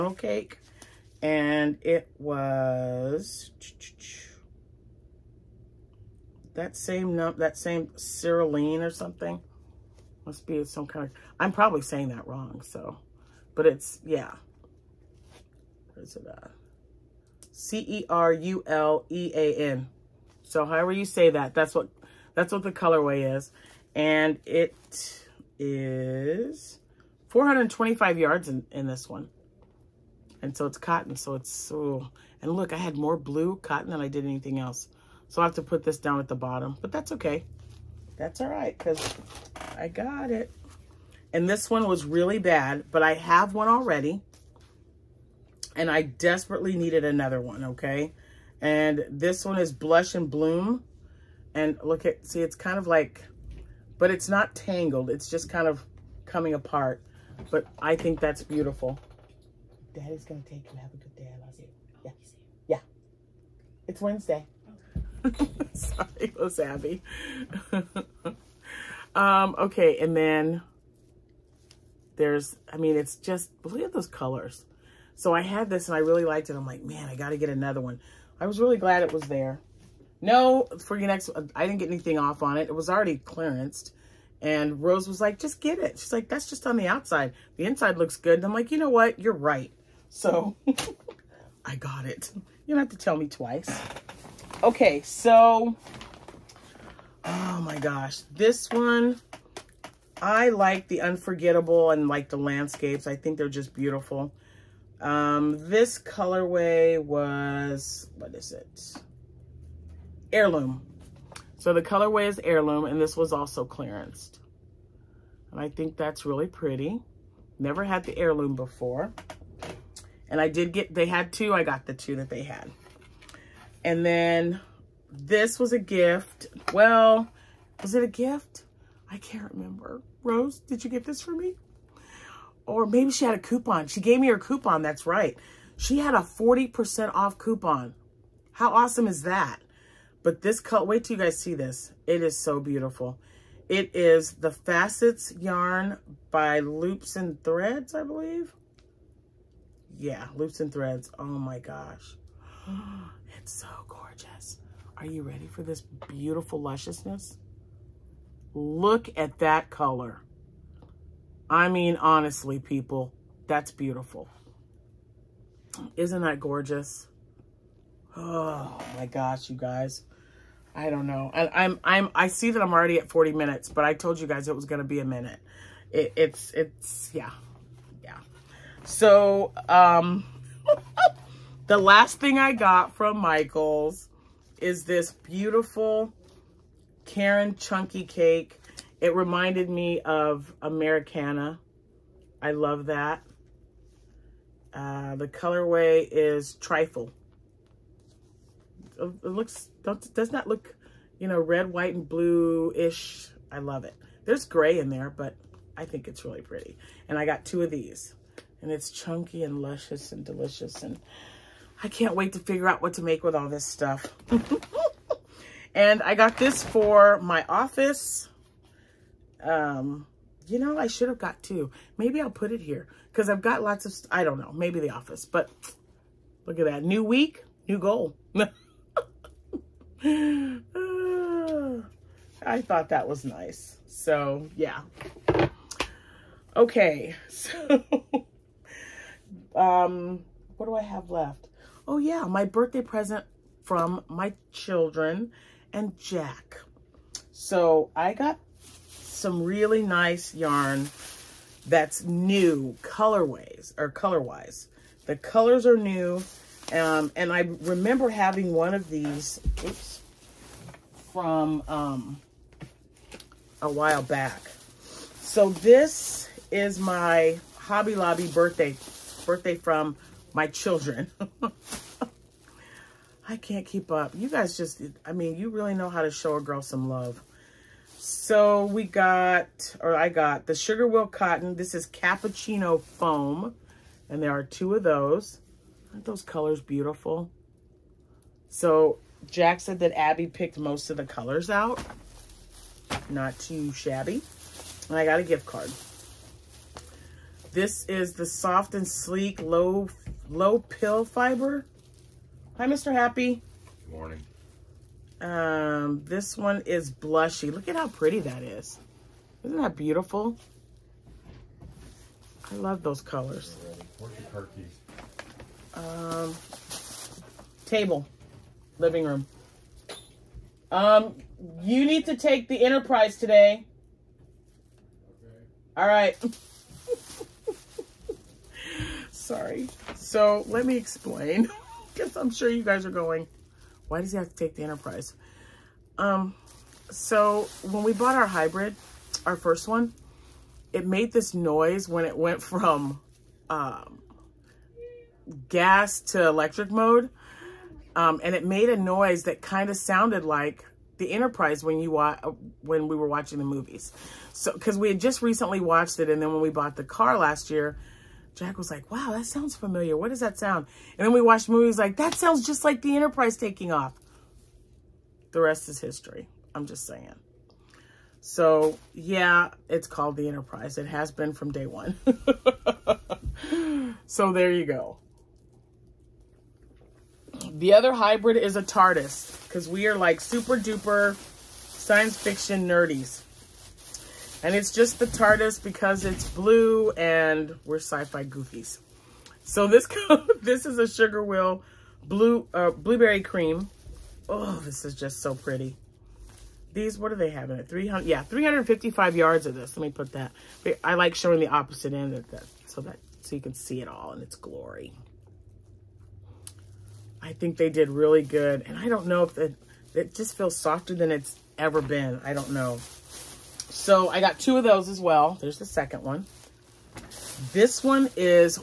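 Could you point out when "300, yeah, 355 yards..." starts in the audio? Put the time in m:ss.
6:37.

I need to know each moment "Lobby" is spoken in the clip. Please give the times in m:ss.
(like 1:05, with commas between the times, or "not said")
4:27.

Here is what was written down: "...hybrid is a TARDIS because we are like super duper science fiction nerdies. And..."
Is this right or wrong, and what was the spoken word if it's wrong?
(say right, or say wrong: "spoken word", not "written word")
right.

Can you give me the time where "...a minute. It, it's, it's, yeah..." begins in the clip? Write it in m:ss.
2:54.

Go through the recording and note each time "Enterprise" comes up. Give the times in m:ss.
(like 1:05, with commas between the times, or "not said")
5:22, 5:34, 5:51, 6:02, 6:10.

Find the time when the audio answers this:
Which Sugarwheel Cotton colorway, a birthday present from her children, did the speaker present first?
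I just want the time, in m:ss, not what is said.
4:41.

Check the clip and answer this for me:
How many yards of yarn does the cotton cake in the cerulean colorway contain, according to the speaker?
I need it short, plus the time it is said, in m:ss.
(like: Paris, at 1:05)
425, at 0:27.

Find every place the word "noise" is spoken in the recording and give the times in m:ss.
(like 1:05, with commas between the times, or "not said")
5:41, 5:48.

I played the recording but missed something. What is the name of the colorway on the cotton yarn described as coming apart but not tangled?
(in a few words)
Blush and Bloom.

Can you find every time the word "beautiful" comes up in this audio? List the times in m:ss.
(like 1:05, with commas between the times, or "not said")
0:58, 1:43, 2:22, 2:36, 2:43, 3:05, 4:46, 5:09.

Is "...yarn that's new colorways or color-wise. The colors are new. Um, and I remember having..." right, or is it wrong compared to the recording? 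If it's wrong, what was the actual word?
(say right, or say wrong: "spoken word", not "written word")
right.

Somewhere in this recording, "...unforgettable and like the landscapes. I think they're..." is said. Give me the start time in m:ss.
1:41.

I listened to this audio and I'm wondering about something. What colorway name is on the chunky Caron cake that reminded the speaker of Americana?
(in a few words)
Trifle.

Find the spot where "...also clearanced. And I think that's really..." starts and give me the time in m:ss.
1:53.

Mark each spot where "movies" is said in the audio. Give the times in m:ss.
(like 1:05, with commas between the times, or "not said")
5:53, 6:01.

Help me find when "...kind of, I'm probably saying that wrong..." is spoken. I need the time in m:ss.
0:10.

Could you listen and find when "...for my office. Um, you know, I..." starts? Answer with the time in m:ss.
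3:36.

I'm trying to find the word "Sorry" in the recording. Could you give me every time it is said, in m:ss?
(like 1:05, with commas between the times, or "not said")
1:05, 5:29.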